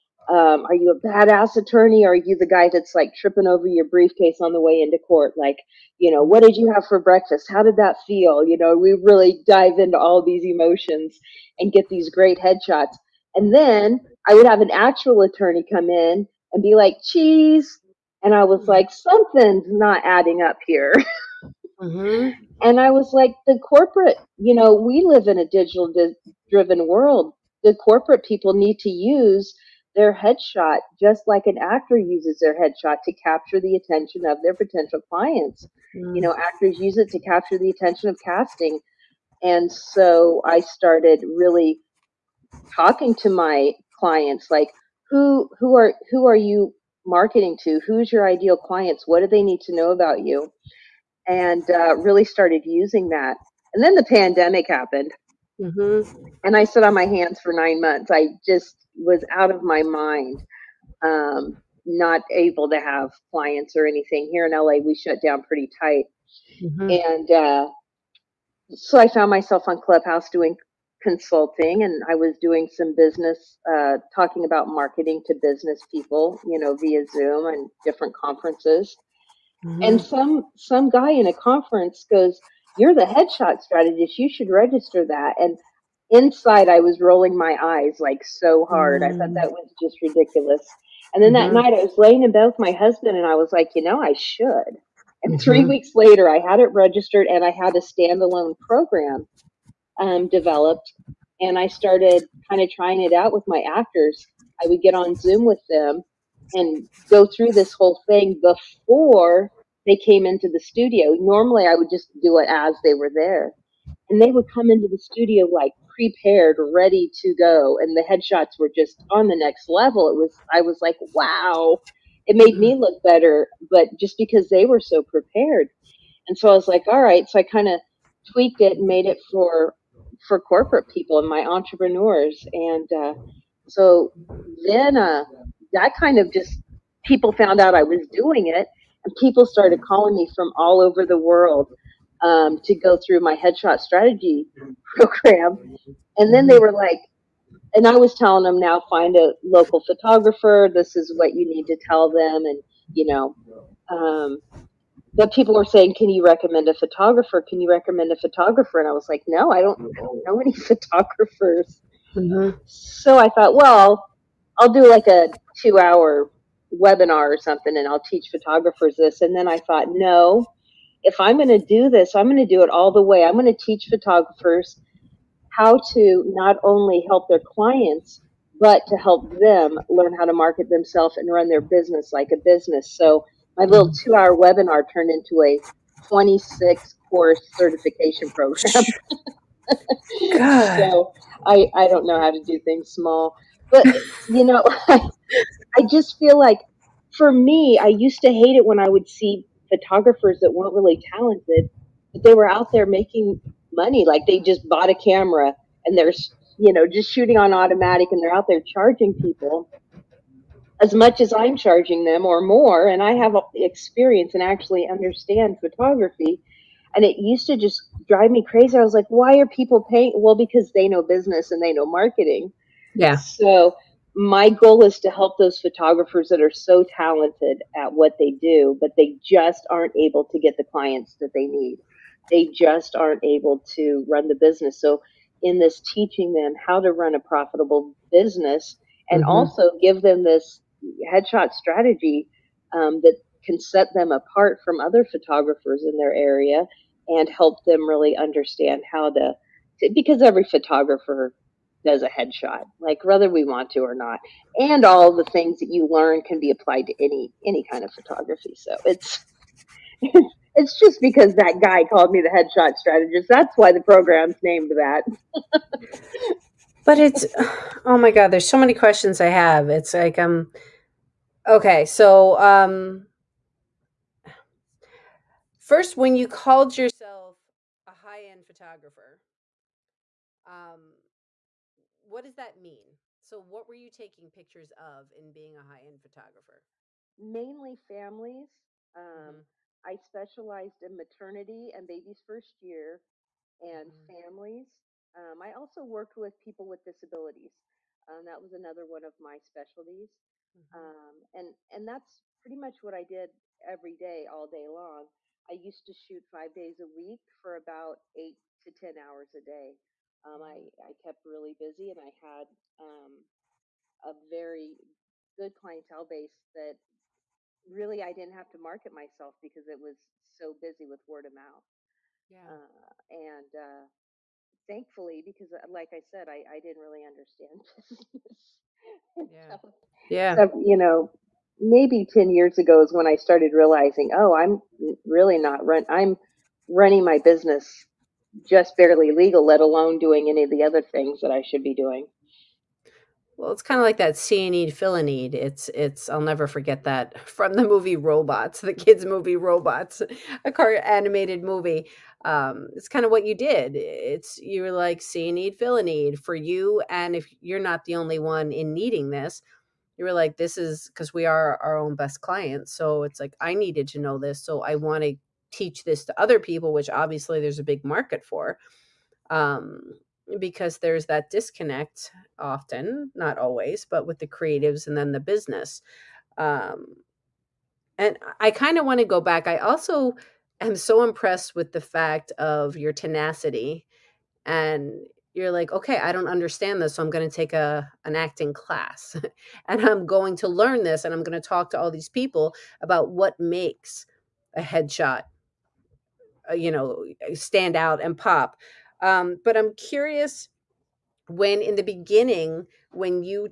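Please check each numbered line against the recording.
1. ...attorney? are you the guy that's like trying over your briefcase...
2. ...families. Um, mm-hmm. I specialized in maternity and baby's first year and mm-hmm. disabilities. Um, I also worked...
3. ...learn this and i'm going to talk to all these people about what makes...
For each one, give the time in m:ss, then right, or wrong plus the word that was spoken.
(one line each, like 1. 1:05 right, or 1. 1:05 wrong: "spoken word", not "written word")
1. 0:01 wrong: "tripping", not "trying"
2. 4:47 wrong: "families", not "disabilities"
3. 6:30 right.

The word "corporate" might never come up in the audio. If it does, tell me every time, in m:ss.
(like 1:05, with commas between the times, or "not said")
0:23, 0:27, 2:10.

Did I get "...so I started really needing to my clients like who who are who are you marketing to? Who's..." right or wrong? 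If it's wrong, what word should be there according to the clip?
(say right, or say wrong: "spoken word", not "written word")
wrong: "talking", not "needing".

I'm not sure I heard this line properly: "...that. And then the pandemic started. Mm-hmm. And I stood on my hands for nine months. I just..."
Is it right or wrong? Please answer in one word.
wrong.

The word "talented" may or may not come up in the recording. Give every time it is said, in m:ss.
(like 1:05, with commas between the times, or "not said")
3:21, 3:46.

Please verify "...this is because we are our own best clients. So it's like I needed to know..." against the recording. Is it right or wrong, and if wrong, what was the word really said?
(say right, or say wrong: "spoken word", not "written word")
right.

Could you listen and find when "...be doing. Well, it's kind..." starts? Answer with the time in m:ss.
5:41.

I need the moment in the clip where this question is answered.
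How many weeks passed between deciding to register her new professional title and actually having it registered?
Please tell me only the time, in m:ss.
1:35.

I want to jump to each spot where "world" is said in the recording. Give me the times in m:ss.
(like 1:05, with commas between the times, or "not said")
0:26, 2:21.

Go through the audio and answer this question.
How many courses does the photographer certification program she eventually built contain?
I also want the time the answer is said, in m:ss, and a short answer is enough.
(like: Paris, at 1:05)
26, at 3:06.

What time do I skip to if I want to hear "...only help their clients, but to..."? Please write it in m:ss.
2:56.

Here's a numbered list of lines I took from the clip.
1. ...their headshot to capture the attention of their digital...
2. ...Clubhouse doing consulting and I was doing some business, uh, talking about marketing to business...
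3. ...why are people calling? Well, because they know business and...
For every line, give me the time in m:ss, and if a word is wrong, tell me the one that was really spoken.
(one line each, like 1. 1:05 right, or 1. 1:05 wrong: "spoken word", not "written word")
1. 0:32 wrong: "potential", not "digital"
2. 1:09 right
3. 3:39 wrong: "paying", not "calling".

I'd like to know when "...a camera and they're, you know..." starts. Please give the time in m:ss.
3:24.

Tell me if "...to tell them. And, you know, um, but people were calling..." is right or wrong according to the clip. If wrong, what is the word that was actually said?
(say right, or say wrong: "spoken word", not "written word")
wrong: "saying", not "calling".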